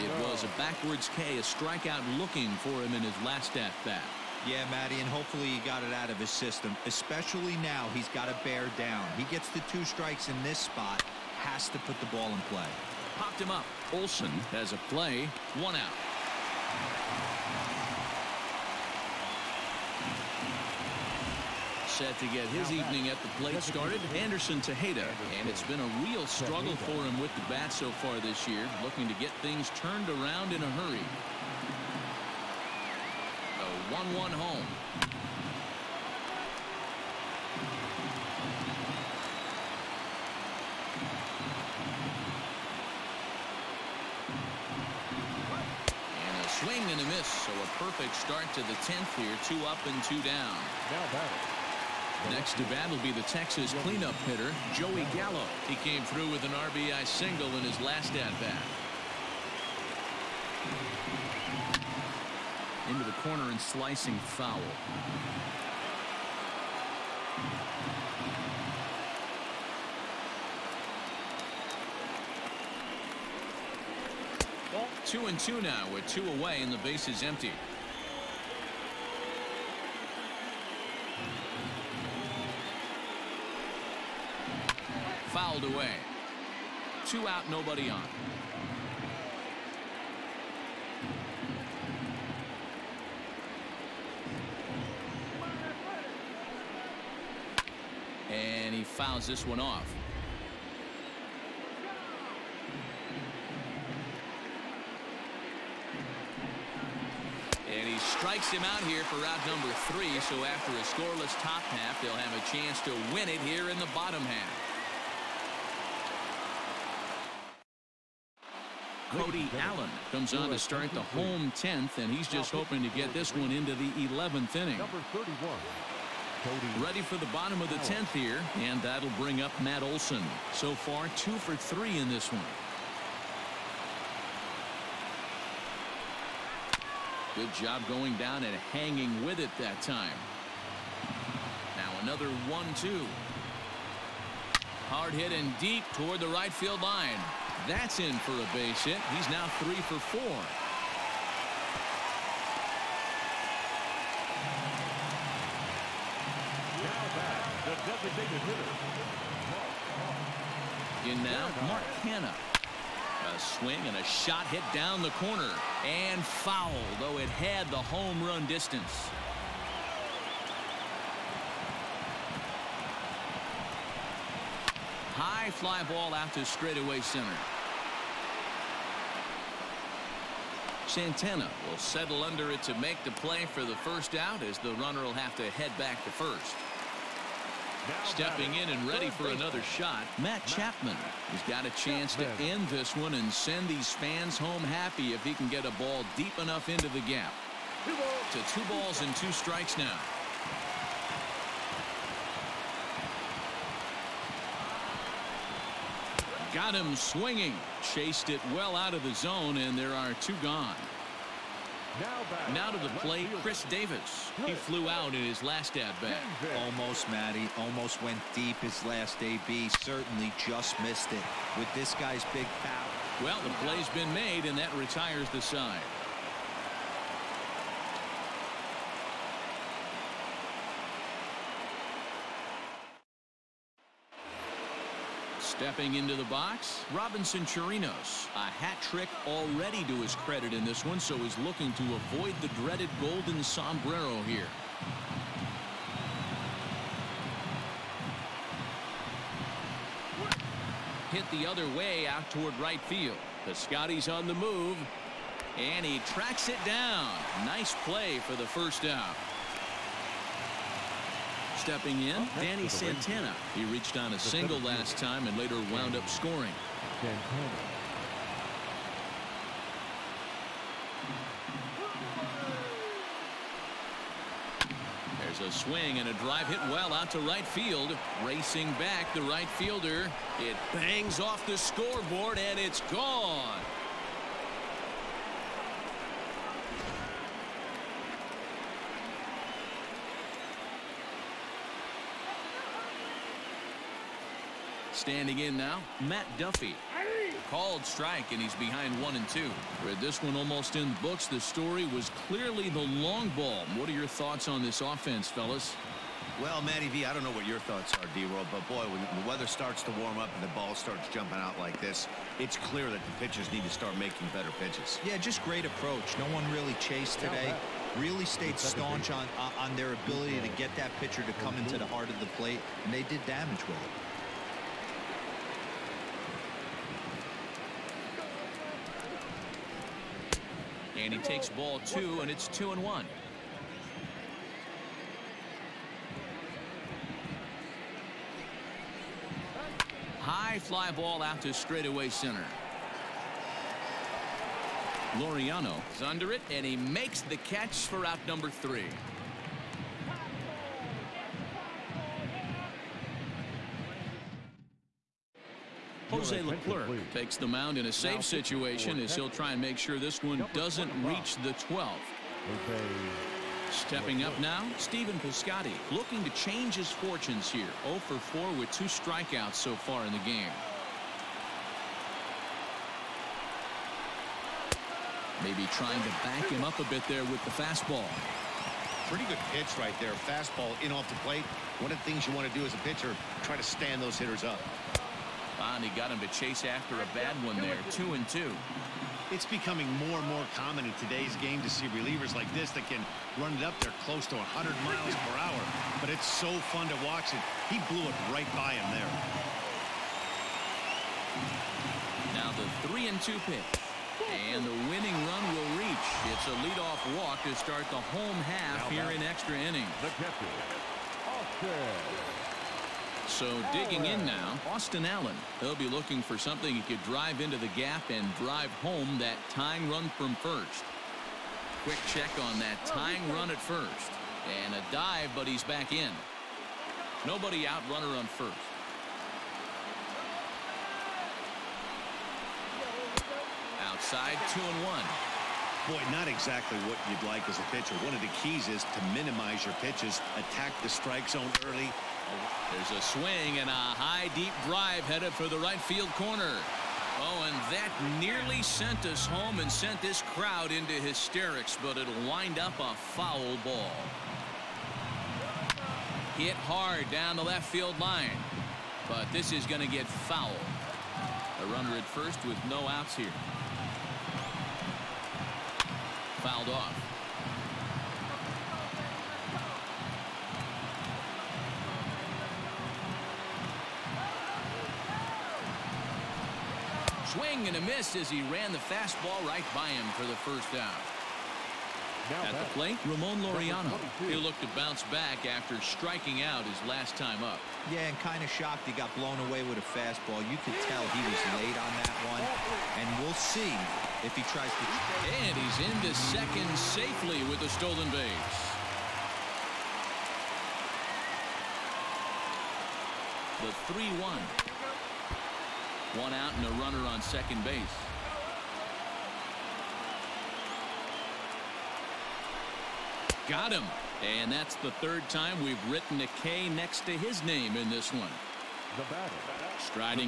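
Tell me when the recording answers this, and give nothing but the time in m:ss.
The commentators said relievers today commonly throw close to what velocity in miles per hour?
6:34.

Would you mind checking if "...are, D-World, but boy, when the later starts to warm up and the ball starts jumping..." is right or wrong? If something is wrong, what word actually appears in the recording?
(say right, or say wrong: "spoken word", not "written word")
wrong: "weather", not "later".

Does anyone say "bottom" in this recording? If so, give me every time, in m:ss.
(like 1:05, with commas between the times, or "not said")
1:53, 2:07.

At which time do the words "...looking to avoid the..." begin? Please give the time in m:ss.
4:01.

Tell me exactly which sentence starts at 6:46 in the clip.
It's a leadoff walk to start the home half now here in extra innings.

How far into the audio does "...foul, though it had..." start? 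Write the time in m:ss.
2:46.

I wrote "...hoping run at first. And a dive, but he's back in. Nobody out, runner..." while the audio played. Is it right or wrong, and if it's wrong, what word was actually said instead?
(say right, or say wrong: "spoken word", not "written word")
wrong: "tying", not "hoping".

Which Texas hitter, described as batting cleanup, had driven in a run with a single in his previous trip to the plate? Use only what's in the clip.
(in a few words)
Joey Gallo.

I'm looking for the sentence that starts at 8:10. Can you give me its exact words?
You could tell he was late on that one, and we'll see if he tries to.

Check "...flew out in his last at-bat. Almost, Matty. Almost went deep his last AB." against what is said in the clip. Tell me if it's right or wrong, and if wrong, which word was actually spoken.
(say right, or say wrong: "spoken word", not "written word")
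right.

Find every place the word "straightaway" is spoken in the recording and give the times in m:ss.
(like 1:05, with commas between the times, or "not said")
2:56, 5:41.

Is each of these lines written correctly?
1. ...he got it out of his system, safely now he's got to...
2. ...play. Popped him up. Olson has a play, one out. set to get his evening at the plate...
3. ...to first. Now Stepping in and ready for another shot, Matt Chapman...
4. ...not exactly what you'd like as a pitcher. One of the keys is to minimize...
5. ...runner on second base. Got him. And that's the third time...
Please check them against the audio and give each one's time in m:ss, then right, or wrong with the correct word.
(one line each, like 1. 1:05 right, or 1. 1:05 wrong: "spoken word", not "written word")
1. 0:05 wrong: "especially", not "safely"
2. 0:12 right
3. 3:06 right
4. 7:16 right
5. 8:26 right.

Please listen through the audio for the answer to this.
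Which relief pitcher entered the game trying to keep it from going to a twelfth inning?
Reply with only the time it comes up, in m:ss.
5:56.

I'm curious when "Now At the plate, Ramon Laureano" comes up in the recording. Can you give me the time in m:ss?
8:02.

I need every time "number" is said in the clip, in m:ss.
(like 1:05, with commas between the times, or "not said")
1:49, 5:48.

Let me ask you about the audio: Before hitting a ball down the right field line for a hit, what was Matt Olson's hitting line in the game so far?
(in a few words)
2 for 3.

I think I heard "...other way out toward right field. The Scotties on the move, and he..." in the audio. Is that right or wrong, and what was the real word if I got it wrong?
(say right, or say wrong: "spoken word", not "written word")
right.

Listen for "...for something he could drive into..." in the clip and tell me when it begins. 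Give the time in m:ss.
6:56.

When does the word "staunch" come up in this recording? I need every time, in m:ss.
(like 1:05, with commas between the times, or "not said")
5:18.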